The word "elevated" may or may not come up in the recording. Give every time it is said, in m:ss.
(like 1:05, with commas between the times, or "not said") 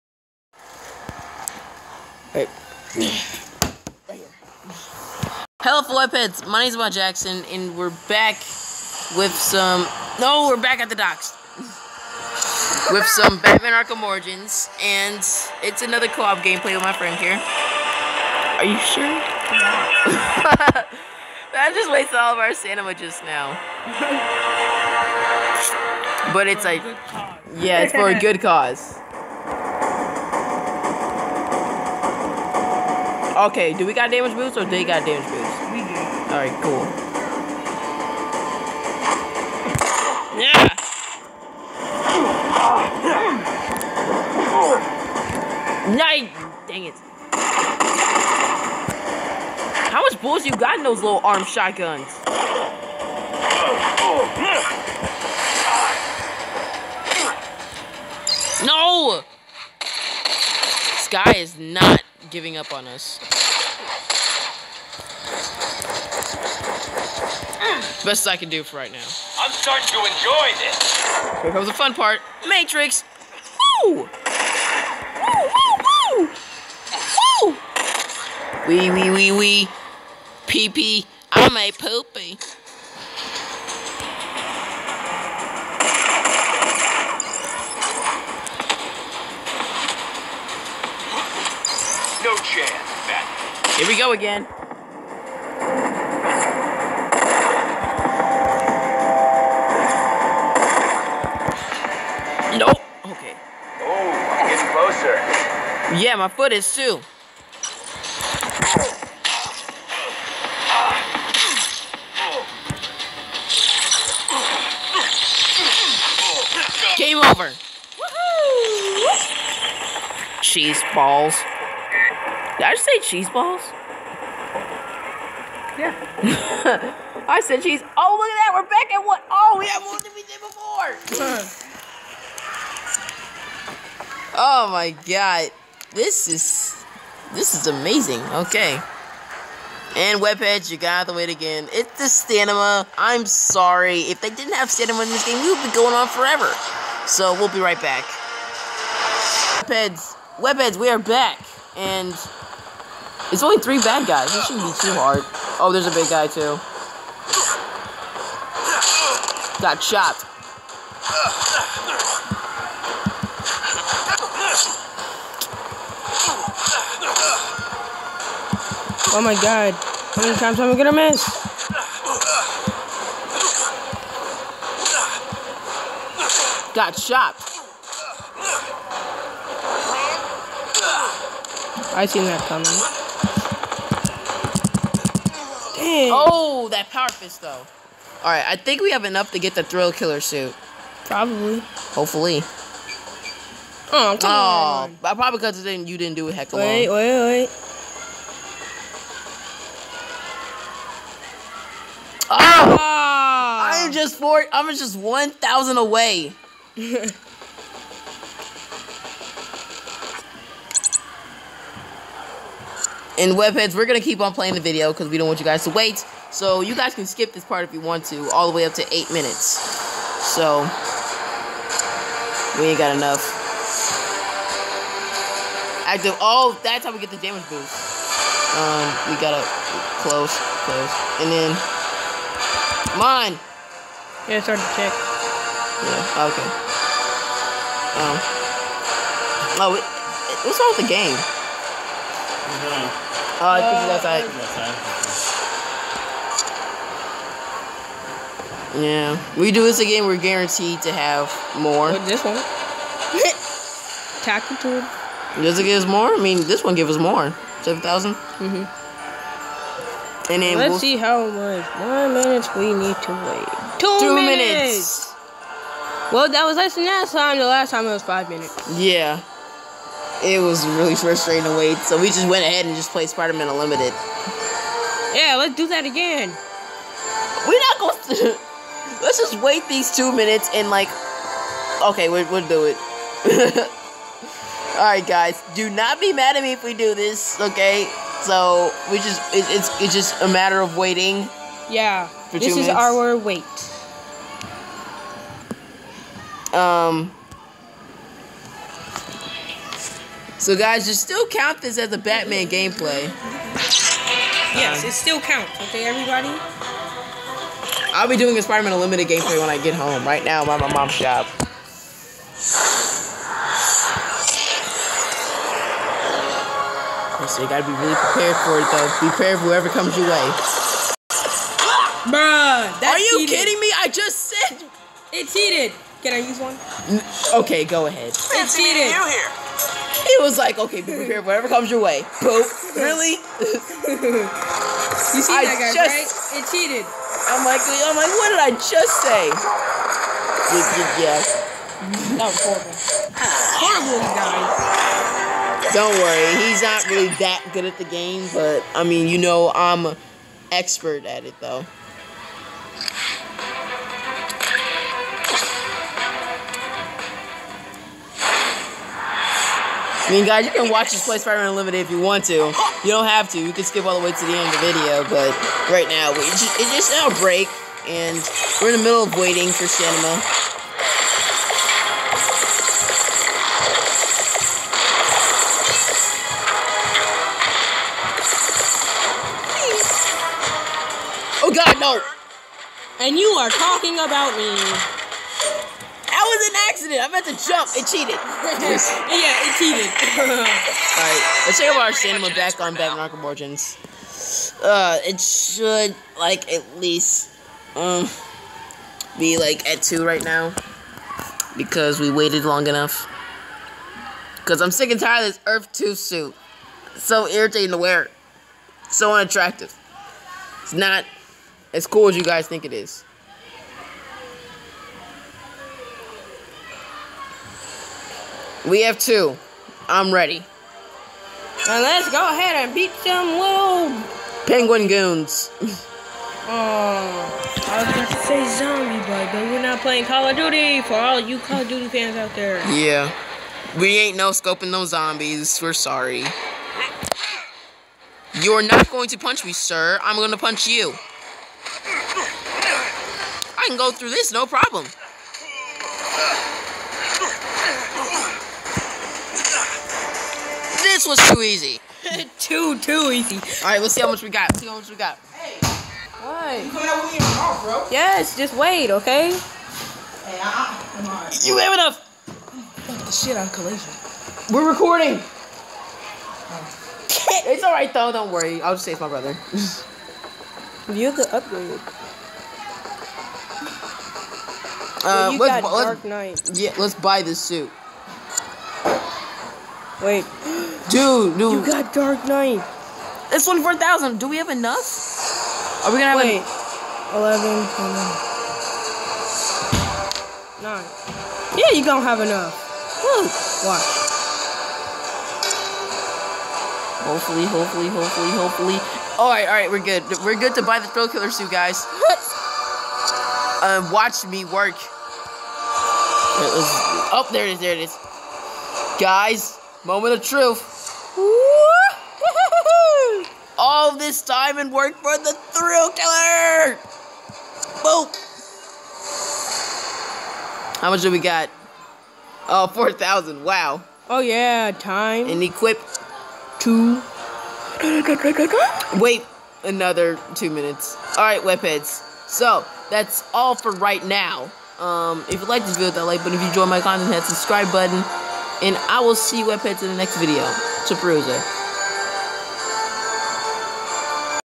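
not said.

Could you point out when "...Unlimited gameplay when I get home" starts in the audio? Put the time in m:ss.
5:08.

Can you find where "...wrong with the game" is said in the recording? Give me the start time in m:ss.
4:00.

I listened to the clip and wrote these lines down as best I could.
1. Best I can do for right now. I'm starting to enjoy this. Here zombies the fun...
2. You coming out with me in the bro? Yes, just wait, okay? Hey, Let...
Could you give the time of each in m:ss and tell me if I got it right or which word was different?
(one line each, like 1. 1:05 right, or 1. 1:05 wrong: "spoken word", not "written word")
1. 1:08 wrong: "comes", not "zombies"
2. 7:36 wrong: "You", not "Let".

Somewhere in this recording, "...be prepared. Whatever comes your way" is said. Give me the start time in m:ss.
5:30.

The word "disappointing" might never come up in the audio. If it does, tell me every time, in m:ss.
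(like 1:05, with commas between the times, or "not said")
not said.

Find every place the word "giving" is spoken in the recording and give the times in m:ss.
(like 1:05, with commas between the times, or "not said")
1:02.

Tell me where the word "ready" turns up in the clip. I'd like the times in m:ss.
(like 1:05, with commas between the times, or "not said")
7:00.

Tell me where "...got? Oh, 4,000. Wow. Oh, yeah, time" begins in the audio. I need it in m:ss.
8:41.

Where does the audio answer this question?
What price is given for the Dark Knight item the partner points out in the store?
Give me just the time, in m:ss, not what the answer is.
8:03.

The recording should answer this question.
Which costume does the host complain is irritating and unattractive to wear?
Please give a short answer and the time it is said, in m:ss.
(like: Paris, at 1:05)
Earth 2 suit, at 6:45.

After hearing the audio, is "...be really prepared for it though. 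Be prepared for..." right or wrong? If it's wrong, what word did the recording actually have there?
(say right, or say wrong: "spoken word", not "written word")
right.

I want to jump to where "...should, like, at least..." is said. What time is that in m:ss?
6:35.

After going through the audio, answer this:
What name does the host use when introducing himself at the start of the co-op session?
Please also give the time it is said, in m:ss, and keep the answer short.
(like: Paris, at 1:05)
Mike Jackson, at 0:06.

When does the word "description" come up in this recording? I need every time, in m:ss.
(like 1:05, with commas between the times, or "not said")
not said.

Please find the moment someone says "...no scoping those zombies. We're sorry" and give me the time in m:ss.
7:14.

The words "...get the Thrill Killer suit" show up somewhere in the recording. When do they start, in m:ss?
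3:09.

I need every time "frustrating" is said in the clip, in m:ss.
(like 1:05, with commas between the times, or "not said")
4:30.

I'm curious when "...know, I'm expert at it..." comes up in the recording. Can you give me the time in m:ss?
5:49.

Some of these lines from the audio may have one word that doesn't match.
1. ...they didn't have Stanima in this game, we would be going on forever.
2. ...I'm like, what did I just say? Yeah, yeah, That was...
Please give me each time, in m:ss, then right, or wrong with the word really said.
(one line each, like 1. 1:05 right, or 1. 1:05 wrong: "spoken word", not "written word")
1. 2:24 right
2. 5:37 right.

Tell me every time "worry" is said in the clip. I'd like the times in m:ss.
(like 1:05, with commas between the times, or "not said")
5:45, 7:48.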